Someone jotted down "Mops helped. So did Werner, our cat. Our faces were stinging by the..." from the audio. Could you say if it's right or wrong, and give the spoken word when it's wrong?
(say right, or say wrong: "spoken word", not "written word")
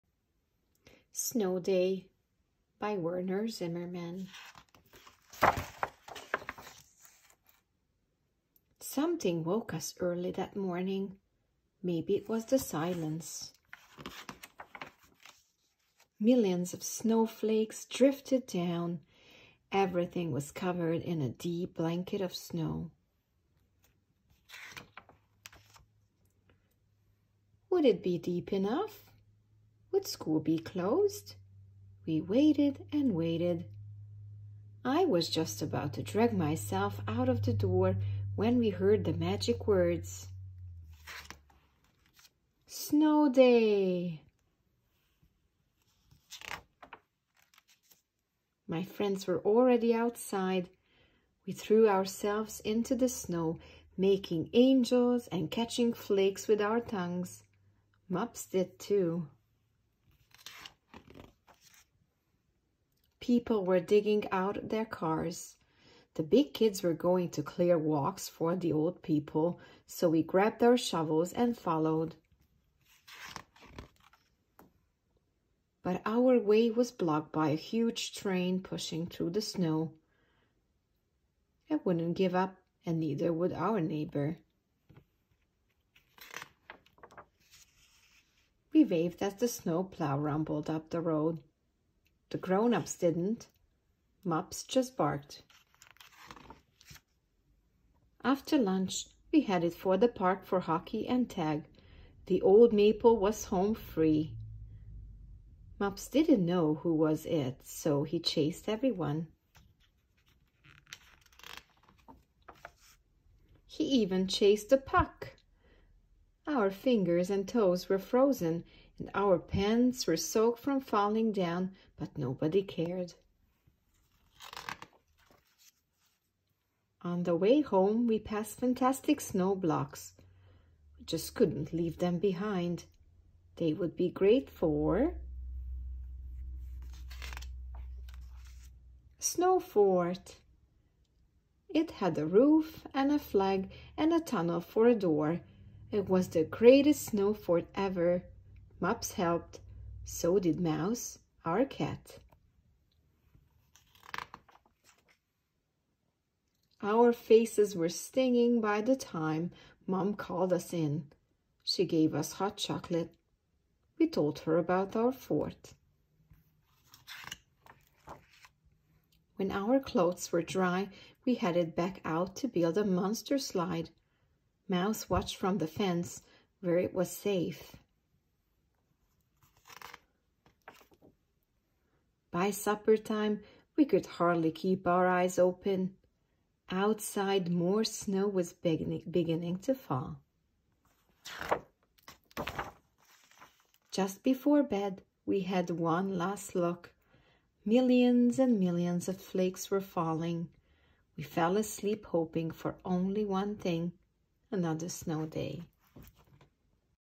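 wrong: "Mouse", not "Werner".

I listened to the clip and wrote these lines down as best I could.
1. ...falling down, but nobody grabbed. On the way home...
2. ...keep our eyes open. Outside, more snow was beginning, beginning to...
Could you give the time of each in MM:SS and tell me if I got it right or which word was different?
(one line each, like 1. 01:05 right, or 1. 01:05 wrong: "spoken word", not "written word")
1. 02:00 wrong: "cared", not "grabbed"
2. 03:04 right.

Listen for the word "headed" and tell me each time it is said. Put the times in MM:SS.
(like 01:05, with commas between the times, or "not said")
01:39, 02:51.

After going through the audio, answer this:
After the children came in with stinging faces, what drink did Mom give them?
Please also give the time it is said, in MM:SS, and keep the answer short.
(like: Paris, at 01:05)
Hot chocolate, at 02:42.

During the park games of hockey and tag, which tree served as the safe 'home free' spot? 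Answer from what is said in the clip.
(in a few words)
The old maple.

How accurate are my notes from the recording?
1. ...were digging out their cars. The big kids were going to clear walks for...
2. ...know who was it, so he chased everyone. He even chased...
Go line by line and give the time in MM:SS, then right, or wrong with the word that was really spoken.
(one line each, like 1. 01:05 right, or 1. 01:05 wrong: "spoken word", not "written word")
1. 01:03 right
2. 01:46 right.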